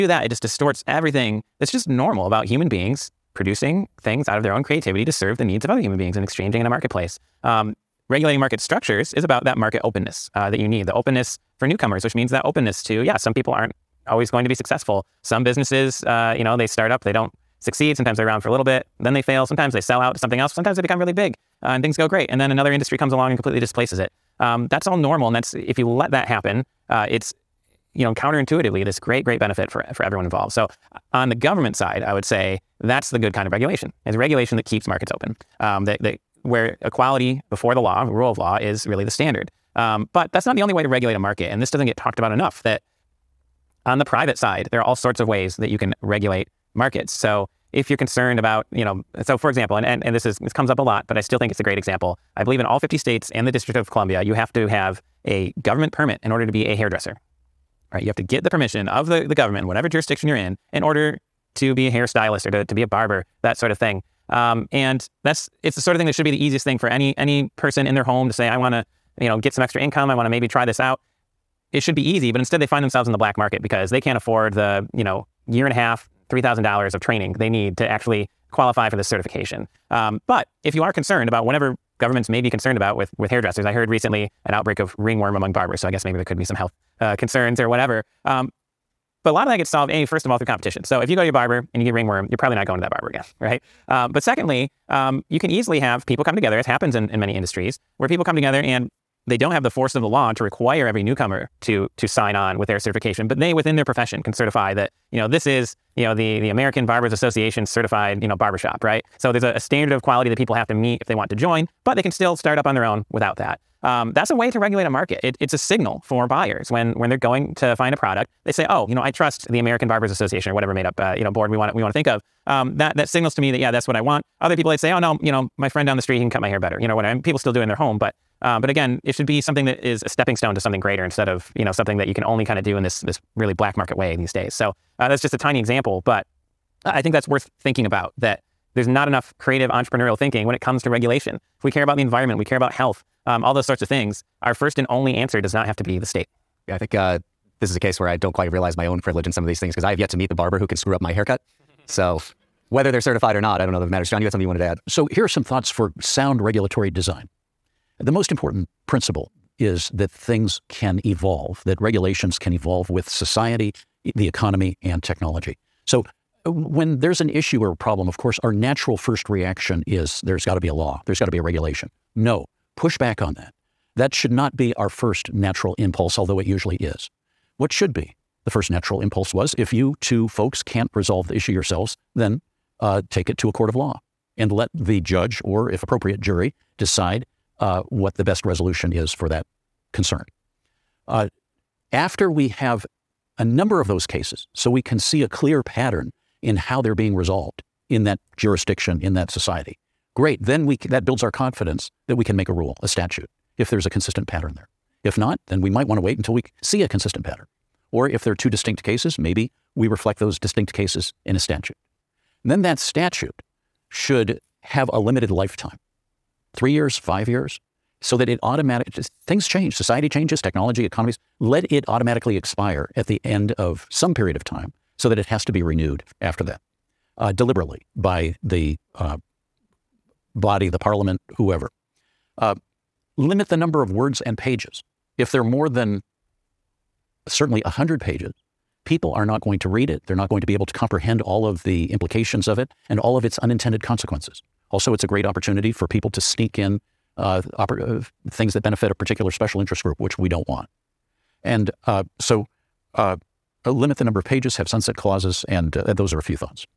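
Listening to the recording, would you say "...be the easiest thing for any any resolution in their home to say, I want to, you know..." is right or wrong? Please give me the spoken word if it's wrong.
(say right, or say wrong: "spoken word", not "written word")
wrong: "person", not "resolution".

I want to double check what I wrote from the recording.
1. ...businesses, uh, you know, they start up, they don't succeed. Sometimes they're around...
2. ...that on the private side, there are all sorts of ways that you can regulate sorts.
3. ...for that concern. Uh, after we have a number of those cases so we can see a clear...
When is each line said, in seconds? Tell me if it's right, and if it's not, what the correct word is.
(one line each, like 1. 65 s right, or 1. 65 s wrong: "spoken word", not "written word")
1. 15 s right
2. 42 s wrong: "markets", not "sorts"
3. 189 s right.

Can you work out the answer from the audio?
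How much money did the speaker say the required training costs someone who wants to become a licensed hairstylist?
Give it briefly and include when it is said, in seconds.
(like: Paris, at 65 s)
$3,000, at 76 s.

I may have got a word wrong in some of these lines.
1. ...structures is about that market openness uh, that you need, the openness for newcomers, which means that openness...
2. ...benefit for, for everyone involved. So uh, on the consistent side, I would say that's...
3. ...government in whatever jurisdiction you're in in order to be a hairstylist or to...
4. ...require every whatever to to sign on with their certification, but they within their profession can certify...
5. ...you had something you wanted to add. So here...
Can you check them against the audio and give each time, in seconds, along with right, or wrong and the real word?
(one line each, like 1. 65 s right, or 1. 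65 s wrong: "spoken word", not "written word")
1. 8 s right
2. 29 s wrong: "government", not "consistent"
3. 59 s right
4. 100 s wrong: "newcomer", not "whatever"
5. 154 s right.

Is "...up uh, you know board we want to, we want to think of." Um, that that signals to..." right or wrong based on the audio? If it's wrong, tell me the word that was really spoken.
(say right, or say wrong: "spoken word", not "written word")
right.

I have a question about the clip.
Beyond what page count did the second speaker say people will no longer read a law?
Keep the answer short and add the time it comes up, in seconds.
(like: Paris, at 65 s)
100 pages, at 237 s.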